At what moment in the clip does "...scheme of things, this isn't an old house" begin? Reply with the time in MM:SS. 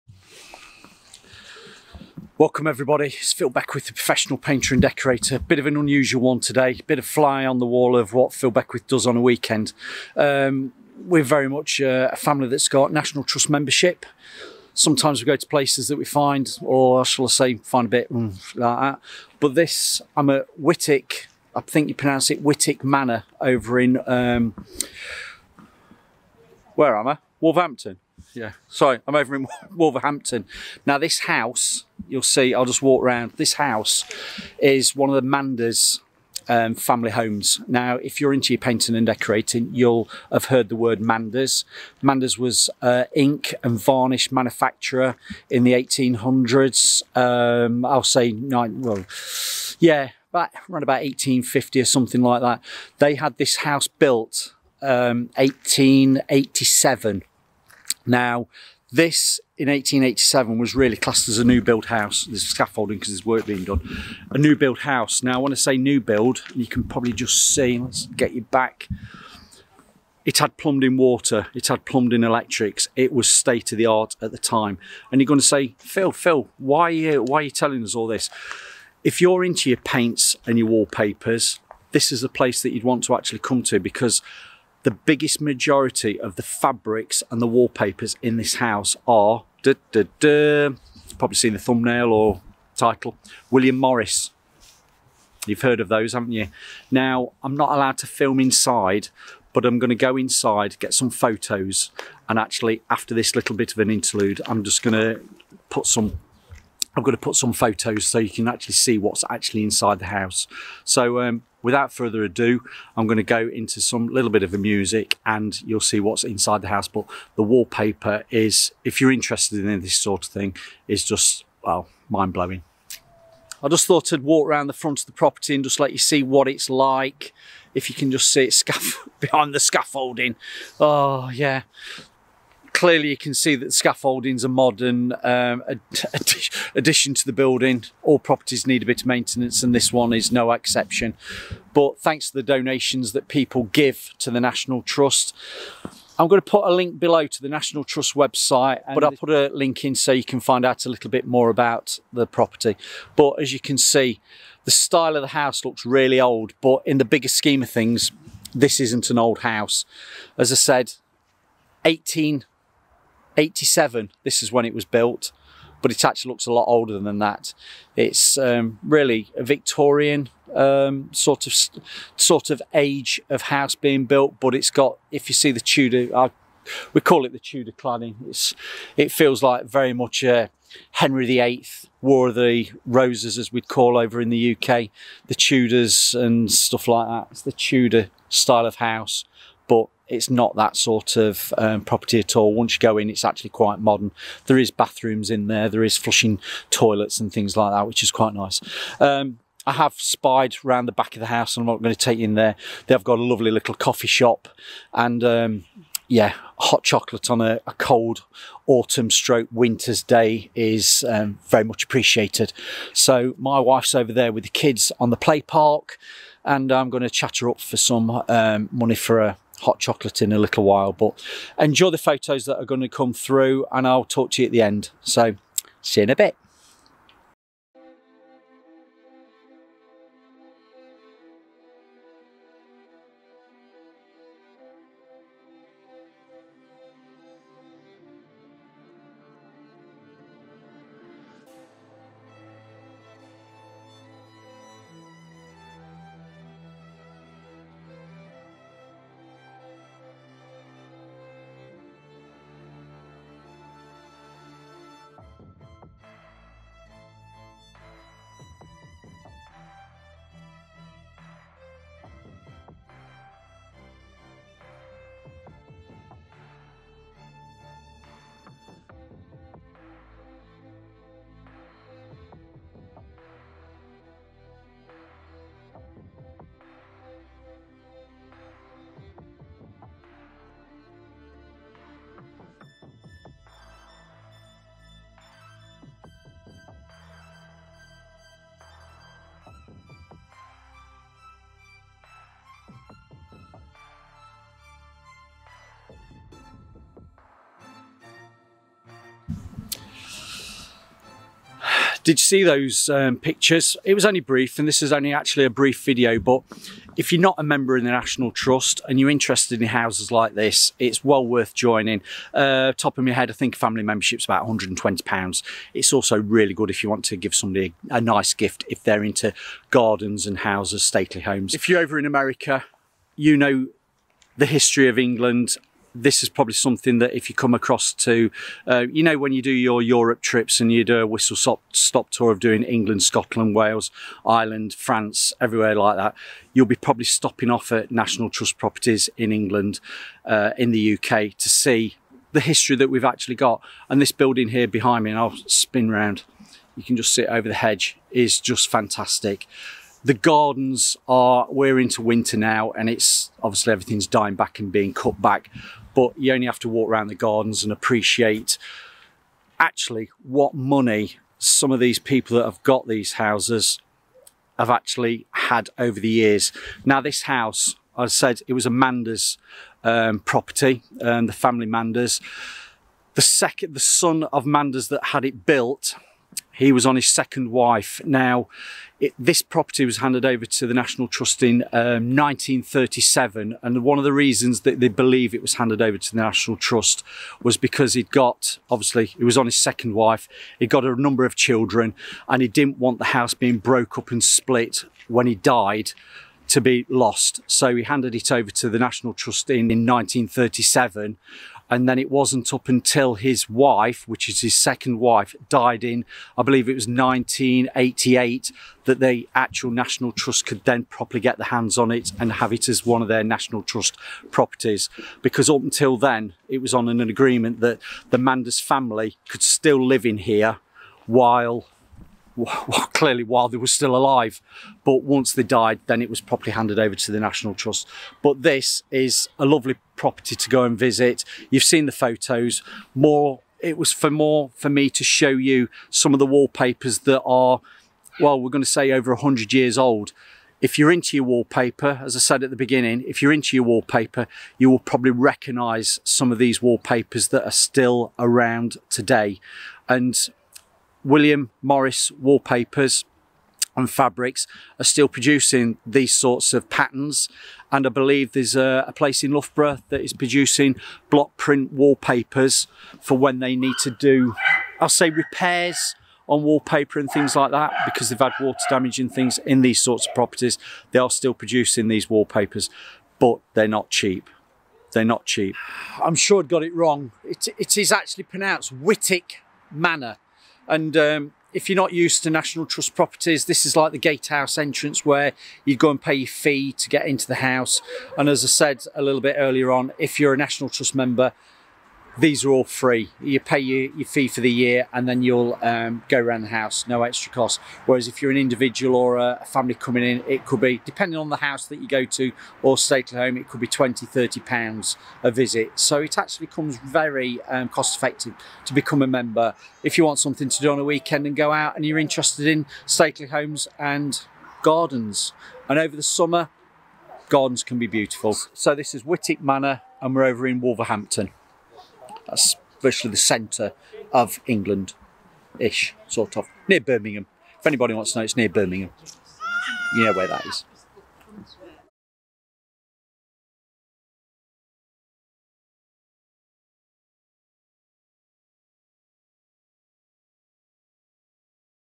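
02:37.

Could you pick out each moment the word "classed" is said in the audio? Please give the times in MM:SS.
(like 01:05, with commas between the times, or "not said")
01:00.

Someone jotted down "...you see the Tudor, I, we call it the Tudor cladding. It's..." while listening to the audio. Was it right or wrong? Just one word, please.
right.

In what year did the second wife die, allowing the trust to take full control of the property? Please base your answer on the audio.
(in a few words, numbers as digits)
1988.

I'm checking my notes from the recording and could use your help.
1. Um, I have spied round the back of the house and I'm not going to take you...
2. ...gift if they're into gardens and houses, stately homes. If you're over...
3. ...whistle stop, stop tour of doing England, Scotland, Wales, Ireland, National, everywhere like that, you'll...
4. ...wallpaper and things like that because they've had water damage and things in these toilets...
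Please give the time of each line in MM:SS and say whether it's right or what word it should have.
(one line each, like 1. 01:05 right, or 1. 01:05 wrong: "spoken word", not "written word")
1. 03:18 right
2. 05:18 right
3. 05:31 wrong: "France", not "National"
4. 07:46 wrong: "sorts", not "toilets".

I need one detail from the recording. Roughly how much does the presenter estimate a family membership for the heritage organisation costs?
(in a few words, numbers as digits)
£120.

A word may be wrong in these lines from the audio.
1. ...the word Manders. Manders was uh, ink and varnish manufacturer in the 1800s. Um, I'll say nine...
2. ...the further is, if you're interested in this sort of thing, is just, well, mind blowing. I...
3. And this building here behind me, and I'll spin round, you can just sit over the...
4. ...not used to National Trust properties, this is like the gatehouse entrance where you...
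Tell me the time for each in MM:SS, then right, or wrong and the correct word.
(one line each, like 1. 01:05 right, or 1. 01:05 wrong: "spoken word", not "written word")
1. 00:40 right
2. 01:57 wrong: "wallpaper", not "further"
3. 05:43 right
4. 08:01 right.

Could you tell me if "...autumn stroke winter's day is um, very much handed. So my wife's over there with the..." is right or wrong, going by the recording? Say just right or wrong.
wrong.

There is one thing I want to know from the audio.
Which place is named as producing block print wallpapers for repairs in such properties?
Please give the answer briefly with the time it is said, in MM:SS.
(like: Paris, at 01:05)
Loughborough, at 07:39.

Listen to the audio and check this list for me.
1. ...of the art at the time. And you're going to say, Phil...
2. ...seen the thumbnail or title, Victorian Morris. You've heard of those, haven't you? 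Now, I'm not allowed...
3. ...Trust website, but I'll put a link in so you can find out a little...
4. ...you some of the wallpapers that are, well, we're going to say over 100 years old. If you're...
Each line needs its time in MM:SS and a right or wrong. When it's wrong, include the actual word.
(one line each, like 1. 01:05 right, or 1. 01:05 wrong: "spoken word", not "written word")
1. 01:13 right
2. 01:31 wrong: "William", not "Victorian"
3. 02:27 right
4. 07:15 right.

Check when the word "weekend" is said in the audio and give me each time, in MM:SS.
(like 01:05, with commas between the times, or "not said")
00:09, 08:30.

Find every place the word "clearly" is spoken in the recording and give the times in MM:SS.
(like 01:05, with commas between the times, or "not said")
02:12, 07:02.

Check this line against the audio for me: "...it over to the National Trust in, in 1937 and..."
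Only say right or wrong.
right.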